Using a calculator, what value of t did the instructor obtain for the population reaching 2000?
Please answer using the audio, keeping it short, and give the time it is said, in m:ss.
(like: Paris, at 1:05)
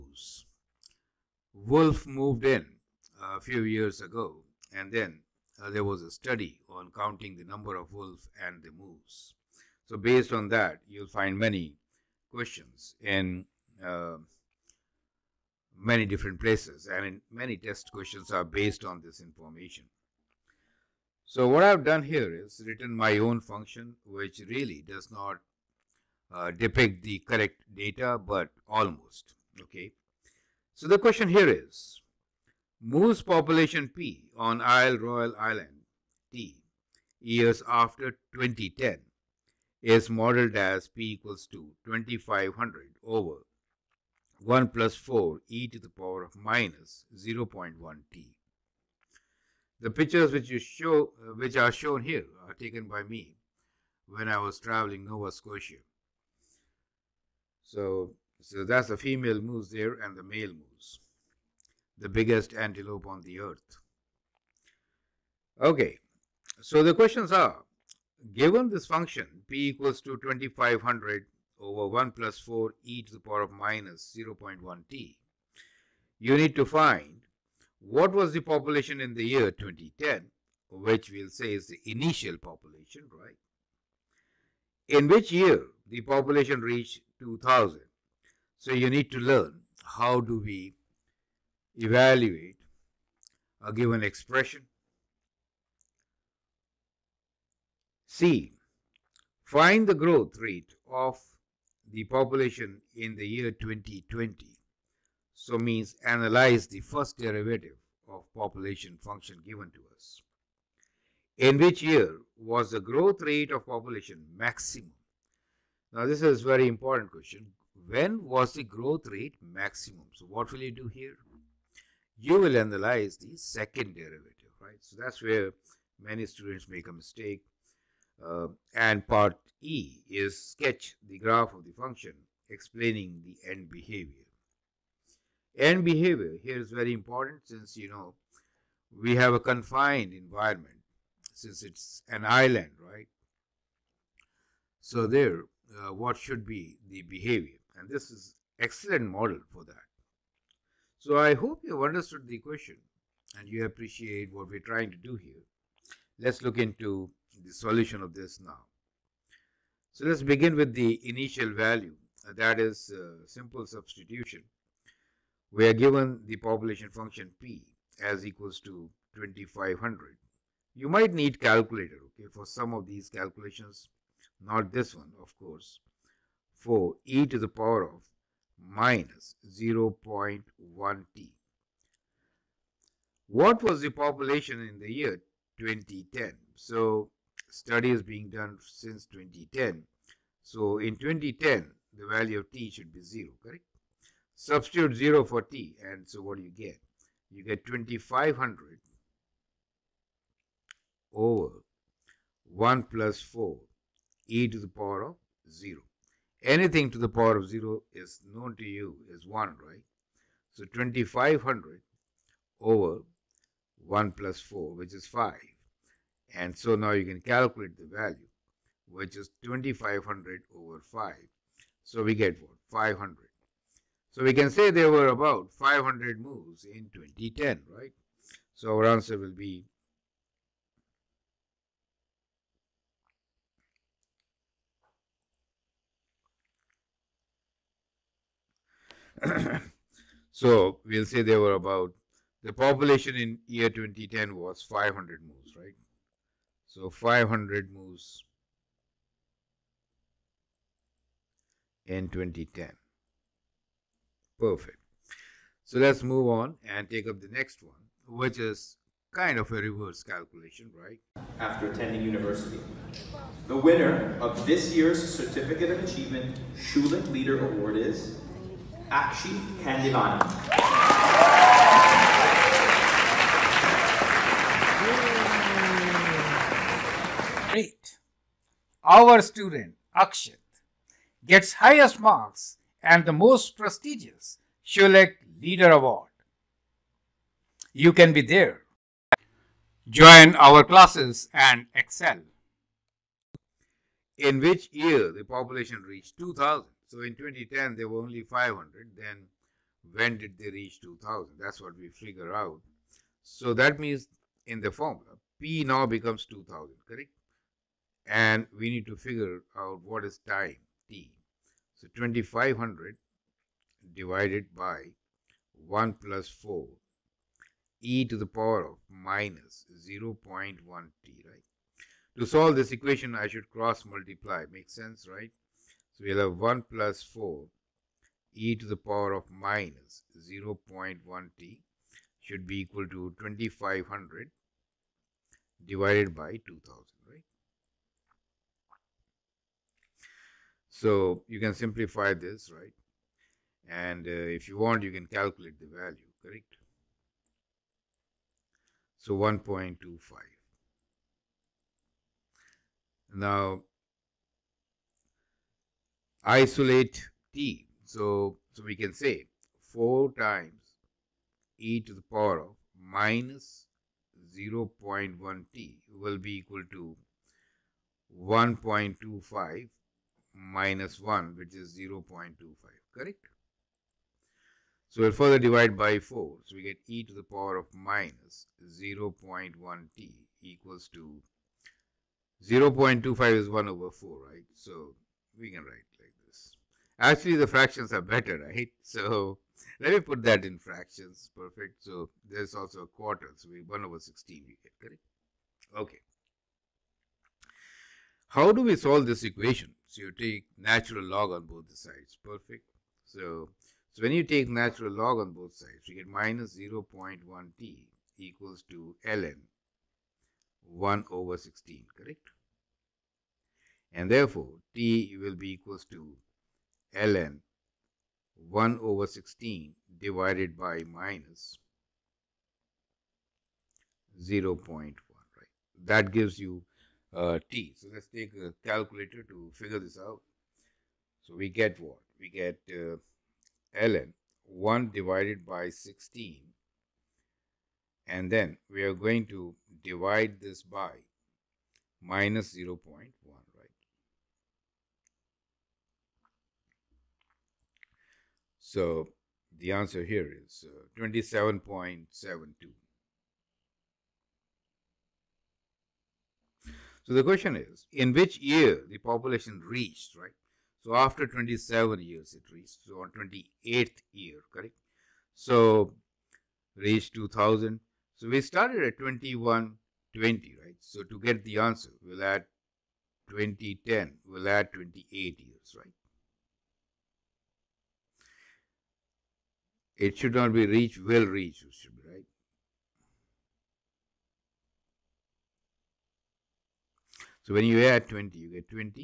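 27.72, at 7:30.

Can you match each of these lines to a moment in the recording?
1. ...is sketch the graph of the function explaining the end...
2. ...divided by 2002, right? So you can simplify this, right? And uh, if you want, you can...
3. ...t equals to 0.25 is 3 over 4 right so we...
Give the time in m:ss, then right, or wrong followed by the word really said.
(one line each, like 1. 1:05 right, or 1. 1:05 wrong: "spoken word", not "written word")
1. 2:10 right
2. 5:35 wrong: "2000", not "2002"
3. 6:19 wrong: "1", not "3".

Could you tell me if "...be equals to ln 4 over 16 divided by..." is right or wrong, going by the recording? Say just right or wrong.
wrong.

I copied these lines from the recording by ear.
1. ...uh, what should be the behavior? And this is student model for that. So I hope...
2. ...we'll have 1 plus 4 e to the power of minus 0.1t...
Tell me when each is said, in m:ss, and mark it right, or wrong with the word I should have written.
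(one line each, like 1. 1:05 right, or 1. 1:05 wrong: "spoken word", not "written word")
1. 2:25 wrong: "excellent", not "student"
2. 5:26 right.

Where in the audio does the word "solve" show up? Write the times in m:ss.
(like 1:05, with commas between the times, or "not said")
5:22, 6:38.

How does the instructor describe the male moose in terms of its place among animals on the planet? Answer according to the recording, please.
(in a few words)
the biggest antelope.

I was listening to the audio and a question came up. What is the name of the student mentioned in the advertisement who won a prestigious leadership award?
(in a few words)
Akshi Kandivani.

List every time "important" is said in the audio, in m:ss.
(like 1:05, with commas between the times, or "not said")
1:56, 2:16.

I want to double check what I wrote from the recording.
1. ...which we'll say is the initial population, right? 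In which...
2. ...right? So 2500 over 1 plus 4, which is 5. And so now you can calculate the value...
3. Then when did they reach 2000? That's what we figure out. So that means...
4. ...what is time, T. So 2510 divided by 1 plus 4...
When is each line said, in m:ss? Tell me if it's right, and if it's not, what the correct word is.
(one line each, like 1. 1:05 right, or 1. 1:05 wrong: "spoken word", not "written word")
1. 1:20 right
2. 3:29 right
3. 4:58 right
4. 5:09 wrong: "2500", not "2510".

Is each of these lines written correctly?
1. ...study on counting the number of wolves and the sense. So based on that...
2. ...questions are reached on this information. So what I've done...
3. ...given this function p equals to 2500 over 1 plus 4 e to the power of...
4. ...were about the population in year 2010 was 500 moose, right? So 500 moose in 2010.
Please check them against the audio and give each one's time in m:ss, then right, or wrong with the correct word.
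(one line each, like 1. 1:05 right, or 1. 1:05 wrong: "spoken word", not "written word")
1. 0:06 wrong: "moose", not "sense"
2. 0:17 wrong: "based", not "reached"
3. 1:08 right
4. 4:01 right.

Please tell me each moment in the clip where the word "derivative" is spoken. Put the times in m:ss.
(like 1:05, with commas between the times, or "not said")
1:47, 2:03.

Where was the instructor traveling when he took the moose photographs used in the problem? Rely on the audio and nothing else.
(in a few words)
Nova Scotia.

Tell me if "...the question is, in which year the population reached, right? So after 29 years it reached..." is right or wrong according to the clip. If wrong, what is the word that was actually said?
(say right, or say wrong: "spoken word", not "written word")
wrong: "27", not "29".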